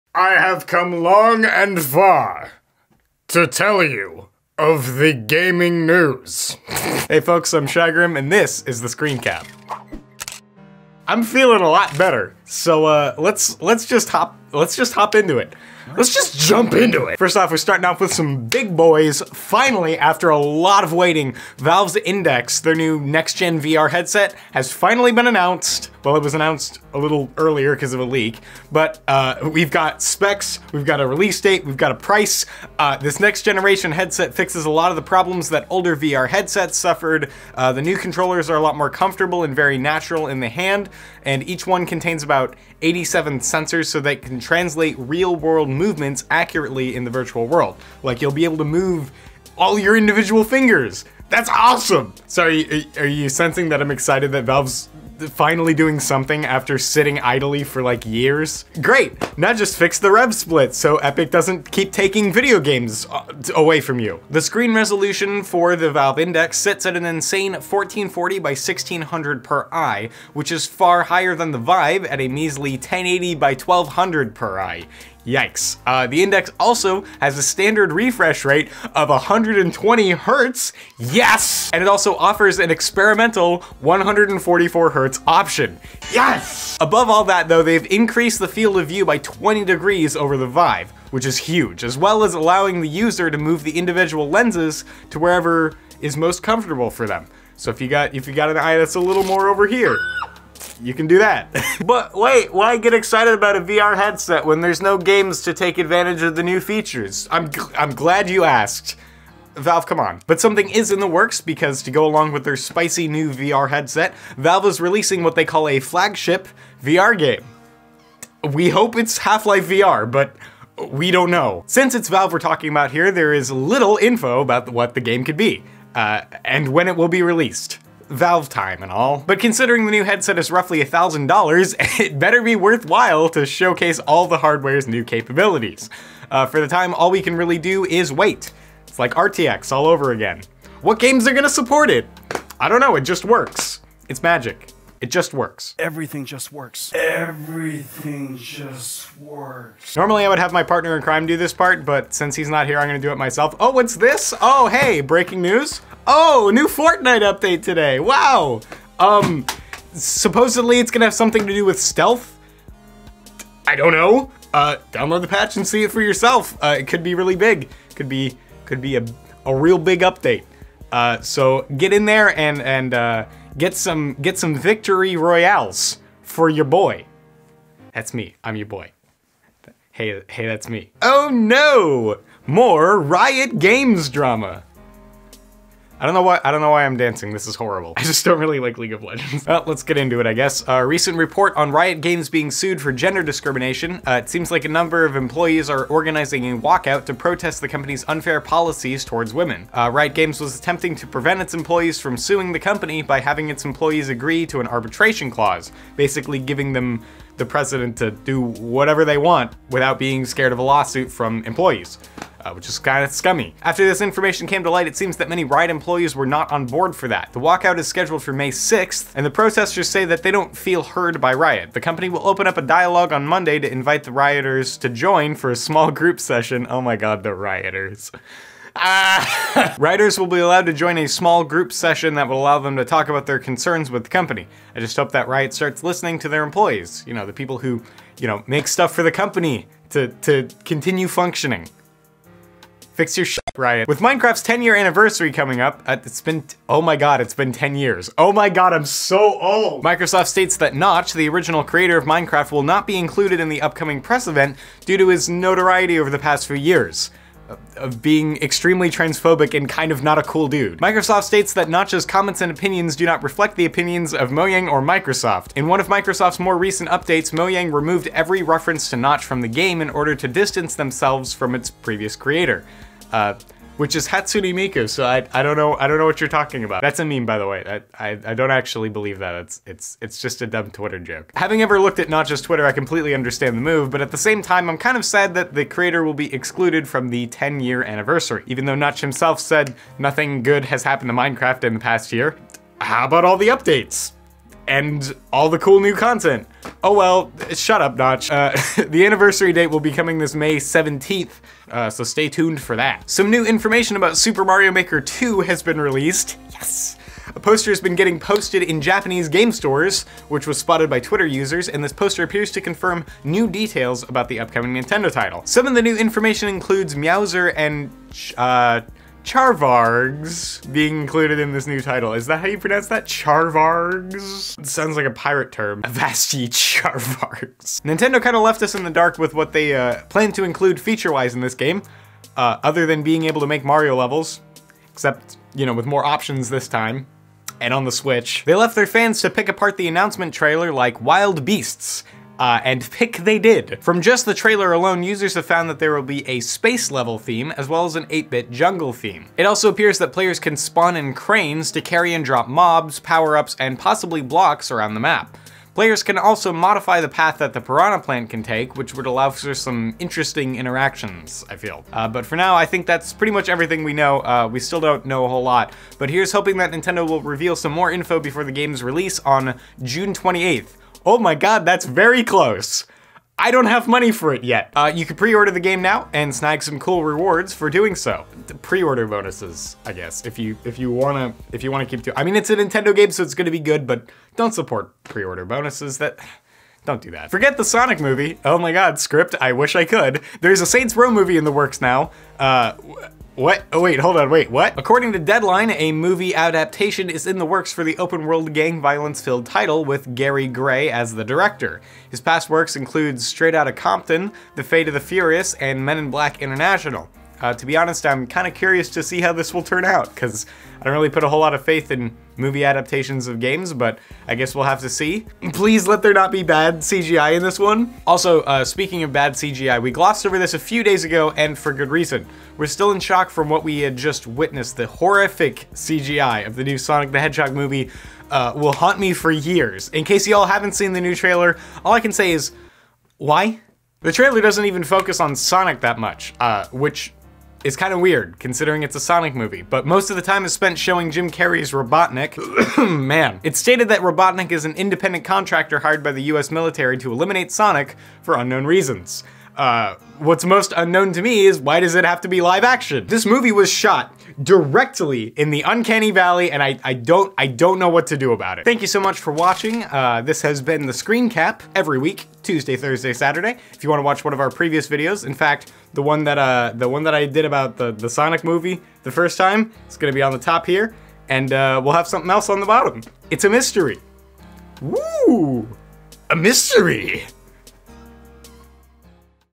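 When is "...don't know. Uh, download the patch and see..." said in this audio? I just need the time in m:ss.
2:43.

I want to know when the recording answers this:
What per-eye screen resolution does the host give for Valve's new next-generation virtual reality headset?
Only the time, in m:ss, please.
1:07.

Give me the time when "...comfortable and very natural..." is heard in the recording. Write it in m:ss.
0:38.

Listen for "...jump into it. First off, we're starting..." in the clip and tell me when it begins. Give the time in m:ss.
0:16.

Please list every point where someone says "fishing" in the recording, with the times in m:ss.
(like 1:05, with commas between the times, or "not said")
not said.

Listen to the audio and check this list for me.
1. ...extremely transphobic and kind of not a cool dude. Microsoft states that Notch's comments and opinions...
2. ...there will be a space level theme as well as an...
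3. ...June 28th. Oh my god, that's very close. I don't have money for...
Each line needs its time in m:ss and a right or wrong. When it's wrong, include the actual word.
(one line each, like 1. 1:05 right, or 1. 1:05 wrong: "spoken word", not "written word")
1. 4:18 right
2. 5:45 right
3. 6:09 right.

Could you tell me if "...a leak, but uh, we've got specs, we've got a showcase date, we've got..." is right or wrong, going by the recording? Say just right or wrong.
wrong.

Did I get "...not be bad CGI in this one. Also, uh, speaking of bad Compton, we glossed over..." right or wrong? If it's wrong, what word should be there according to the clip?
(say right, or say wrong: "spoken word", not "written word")
wrong: "CGI", not "Compton".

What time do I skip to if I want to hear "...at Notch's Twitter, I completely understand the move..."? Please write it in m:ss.
4:41.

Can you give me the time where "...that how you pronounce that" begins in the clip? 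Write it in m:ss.
5:22.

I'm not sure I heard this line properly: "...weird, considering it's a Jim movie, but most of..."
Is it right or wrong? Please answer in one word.
wrong.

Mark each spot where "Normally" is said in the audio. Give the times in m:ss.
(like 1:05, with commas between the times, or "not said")
2:29.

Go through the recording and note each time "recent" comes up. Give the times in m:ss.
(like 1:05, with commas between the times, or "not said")
3:10, 4:26.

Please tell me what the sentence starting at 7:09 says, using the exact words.
In case y'all haven't seen the new trailer, all I can say is, why?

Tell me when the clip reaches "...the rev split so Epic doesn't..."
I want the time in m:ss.
0:59.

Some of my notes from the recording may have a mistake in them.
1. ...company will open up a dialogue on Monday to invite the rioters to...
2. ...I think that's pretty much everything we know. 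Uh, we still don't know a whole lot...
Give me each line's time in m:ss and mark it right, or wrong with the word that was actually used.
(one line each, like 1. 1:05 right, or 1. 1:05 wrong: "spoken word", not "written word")
1. 3:41 right
2. 6:02 right.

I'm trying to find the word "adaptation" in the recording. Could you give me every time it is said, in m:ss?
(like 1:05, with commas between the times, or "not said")
6:36, 6:52.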